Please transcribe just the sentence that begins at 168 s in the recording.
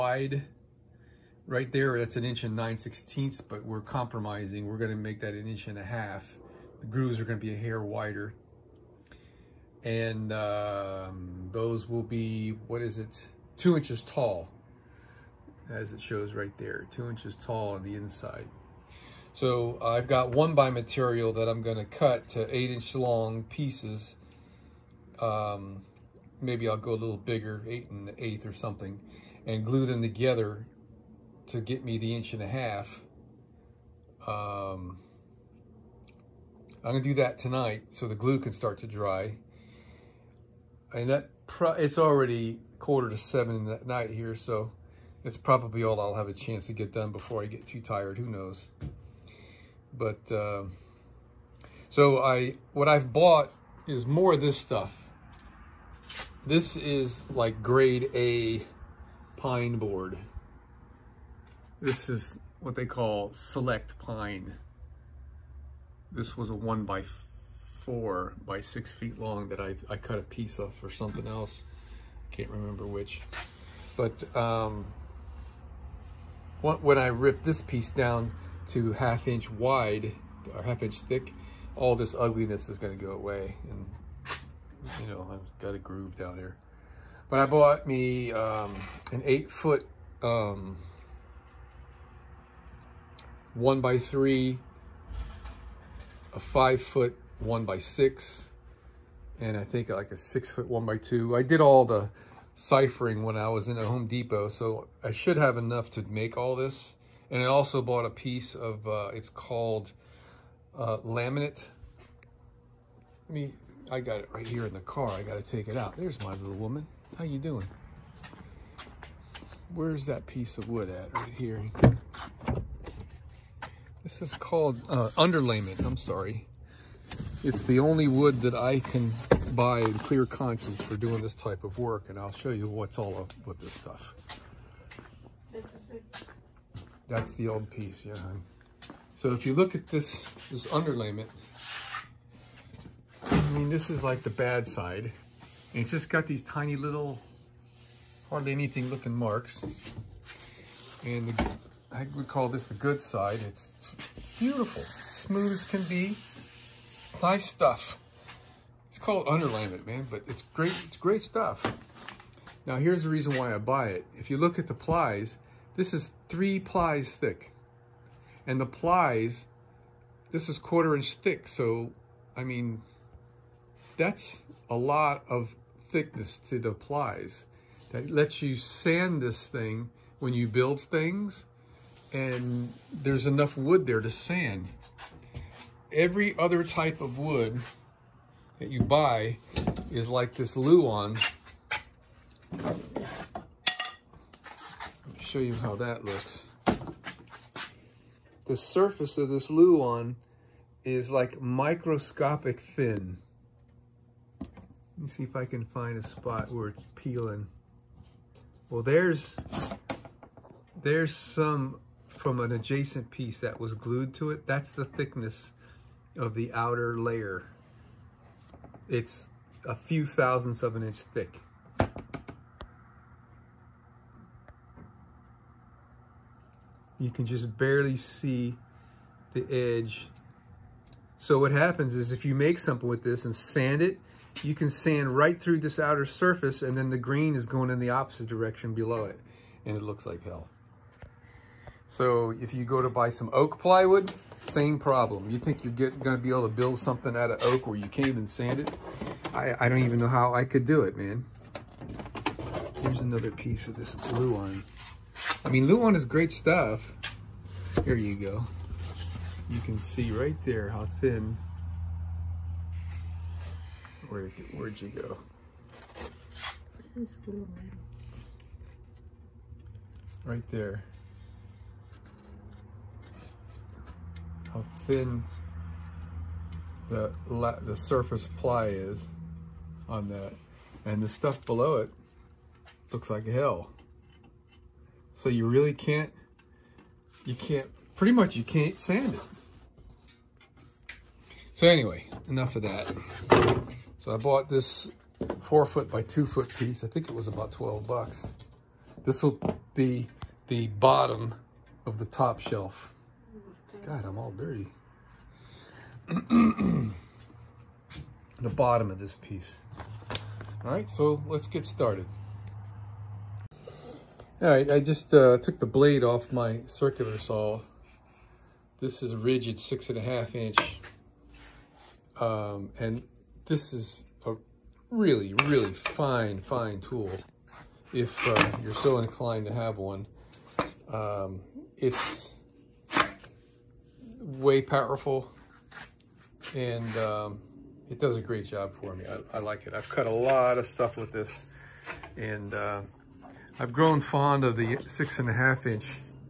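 And the plies, this is quarter inch thick.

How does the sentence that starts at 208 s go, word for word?
Well, there's, there's some from an adjacent piece that was glued to it.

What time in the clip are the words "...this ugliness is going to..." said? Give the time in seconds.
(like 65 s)
81 s.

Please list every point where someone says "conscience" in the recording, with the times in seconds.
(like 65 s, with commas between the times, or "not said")
130 s.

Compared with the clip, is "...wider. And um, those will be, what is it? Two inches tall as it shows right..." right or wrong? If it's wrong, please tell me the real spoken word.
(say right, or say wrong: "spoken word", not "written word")
right.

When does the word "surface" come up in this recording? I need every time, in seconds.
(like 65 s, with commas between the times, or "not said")
198 s, 236 s, 277 s.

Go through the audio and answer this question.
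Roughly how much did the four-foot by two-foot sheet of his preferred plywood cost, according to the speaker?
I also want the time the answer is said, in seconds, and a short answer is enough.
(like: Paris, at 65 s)
12 bucks, at 297 s.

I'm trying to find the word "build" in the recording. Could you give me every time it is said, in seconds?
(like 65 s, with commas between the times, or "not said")
180 s, 246 s.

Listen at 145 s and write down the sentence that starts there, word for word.
And it's just got these tiny little, hardly anything looking marks.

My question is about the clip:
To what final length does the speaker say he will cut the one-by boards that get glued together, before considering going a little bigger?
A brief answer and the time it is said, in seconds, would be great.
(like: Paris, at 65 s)
8 inches, at 22 s.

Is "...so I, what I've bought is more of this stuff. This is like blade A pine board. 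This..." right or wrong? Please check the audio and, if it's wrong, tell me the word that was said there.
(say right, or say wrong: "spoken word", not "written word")
wrong: "grade", not "blade".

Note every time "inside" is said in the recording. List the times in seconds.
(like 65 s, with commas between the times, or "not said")
17 s.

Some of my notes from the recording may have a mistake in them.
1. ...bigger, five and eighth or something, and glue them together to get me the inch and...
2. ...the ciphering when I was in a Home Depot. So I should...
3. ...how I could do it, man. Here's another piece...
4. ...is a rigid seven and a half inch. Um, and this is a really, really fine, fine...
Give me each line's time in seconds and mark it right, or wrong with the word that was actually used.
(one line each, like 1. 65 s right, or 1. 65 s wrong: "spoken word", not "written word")
1. 27 s wrong: "eight", not "five"
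2. 101 s right
3. 250 s right
4. 319 s wrong: "six", not "seven".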